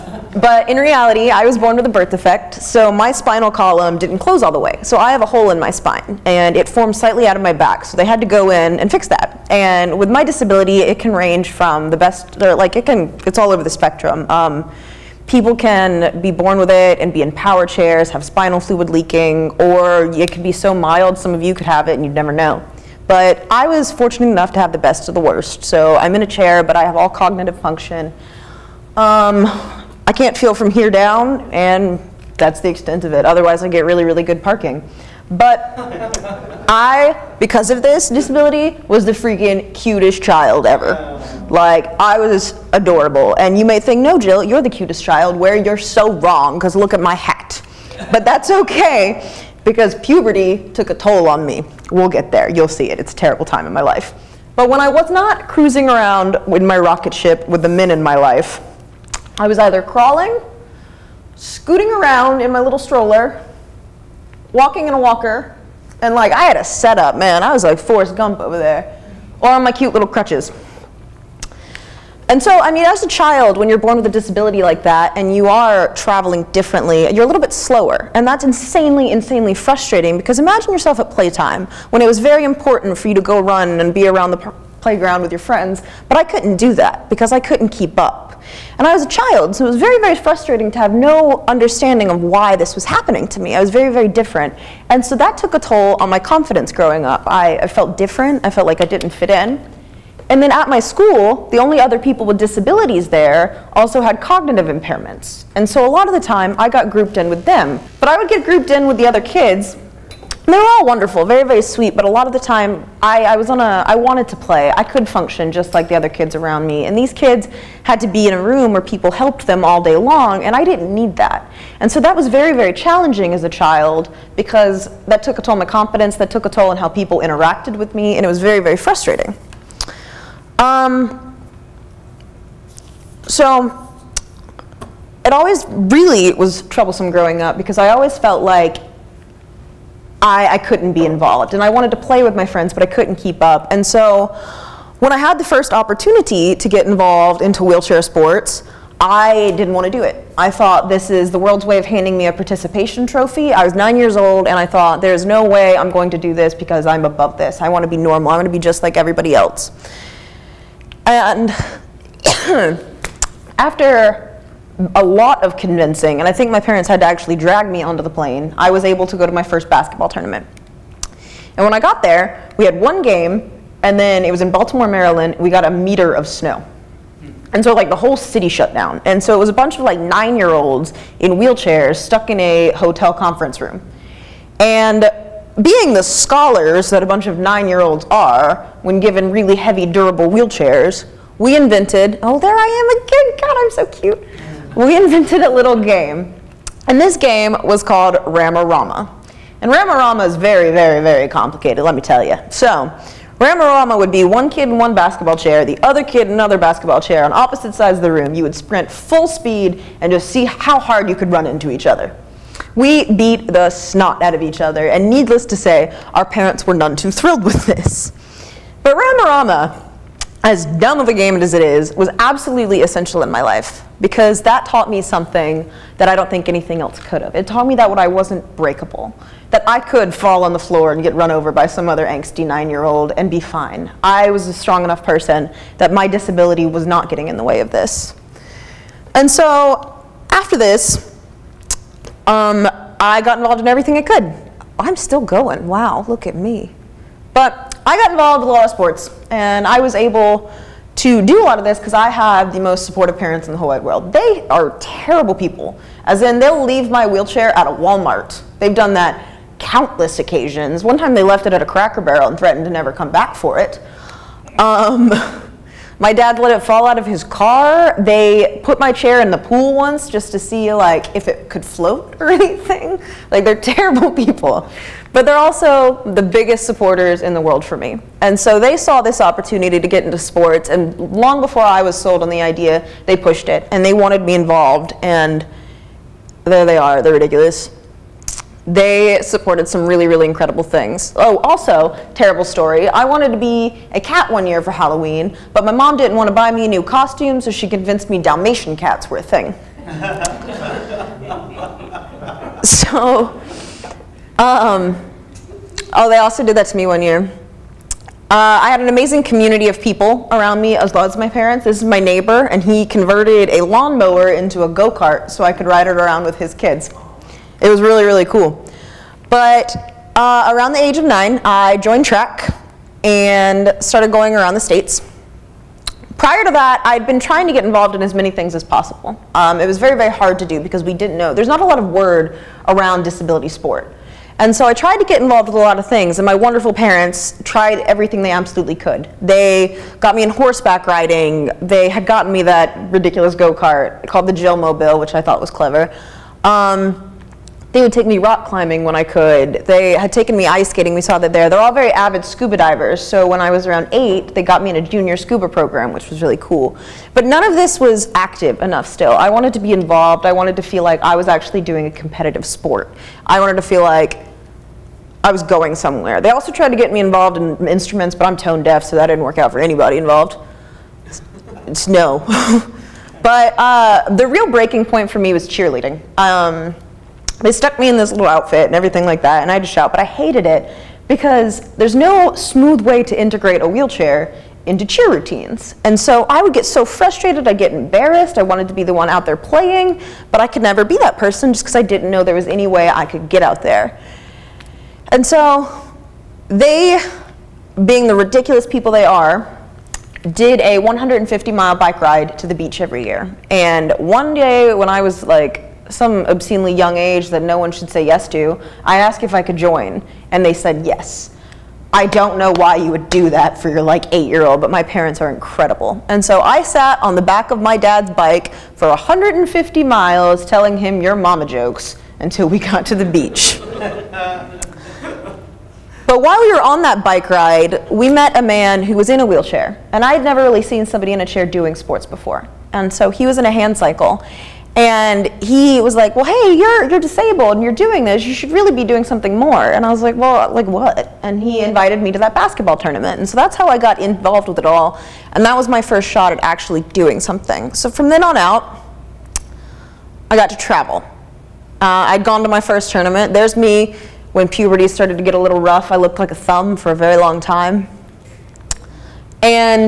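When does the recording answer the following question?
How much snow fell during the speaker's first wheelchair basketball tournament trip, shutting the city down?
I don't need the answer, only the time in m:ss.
2:55.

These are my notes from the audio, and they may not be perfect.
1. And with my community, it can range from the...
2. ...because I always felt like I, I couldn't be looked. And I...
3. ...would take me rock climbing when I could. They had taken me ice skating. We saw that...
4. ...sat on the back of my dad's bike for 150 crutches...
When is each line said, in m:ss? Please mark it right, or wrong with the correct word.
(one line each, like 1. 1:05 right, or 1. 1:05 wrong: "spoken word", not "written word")
1. 0:09 wrong: "disability", not "community"
2. 2:17 wrong: "involved", not "looked"
3. 5:47 right
4. 6:56 wrong: "miles", not "crutches".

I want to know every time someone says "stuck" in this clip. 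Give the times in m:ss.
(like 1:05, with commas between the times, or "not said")
3:01, 6:17.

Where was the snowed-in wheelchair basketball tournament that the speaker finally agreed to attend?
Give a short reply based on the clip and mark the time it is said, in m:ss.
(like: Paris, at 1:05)
Baltimore, Maryland, at 2:54.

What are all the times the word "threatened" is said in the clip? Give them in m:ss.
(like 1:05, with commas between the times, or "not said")
4:22.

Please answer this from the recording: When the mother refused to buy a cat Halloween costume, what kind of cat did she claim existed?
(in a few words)
Dalmatian cats.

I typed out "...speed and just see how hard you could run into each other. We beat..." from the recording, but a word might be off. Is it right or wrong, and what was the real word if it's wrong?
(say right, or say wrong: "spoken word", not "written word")
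right.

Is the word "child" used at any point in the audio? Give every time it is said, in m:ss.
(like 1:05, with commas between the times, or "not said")
0:40, 0:45, 1:13, 1:29, 2:03.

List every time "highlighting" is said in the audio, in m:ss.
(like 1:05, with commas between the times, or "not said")
not said.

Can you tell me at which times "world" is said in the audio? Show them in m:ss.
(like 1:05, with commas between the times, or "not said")
2:31, 4:13, 4:37.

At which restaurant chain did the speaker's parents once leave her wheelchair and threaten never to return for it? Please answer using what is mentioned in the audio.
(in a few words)
Cracker Barrel.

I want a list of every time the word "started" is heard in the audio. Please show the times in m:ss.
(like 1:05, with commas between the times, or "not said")
5:23, 7:34.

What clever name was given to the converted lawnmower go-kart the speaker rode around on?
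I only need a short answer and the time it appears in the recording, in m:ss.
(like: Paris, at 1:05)
Jill Mobile, at 5:44.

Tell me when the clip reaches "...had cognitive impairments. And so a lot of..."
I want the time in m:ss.
1:44.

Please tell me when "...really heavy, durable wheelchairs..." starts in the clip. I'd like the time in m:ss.
3:09.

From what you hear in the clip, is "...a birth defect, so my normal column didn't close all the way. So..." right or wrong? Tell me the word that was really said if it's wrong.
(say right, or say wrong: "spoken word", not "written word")
wrong: "spinal", not "normal".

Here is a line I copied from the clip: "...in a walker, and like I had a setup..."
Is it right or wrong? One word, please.
right.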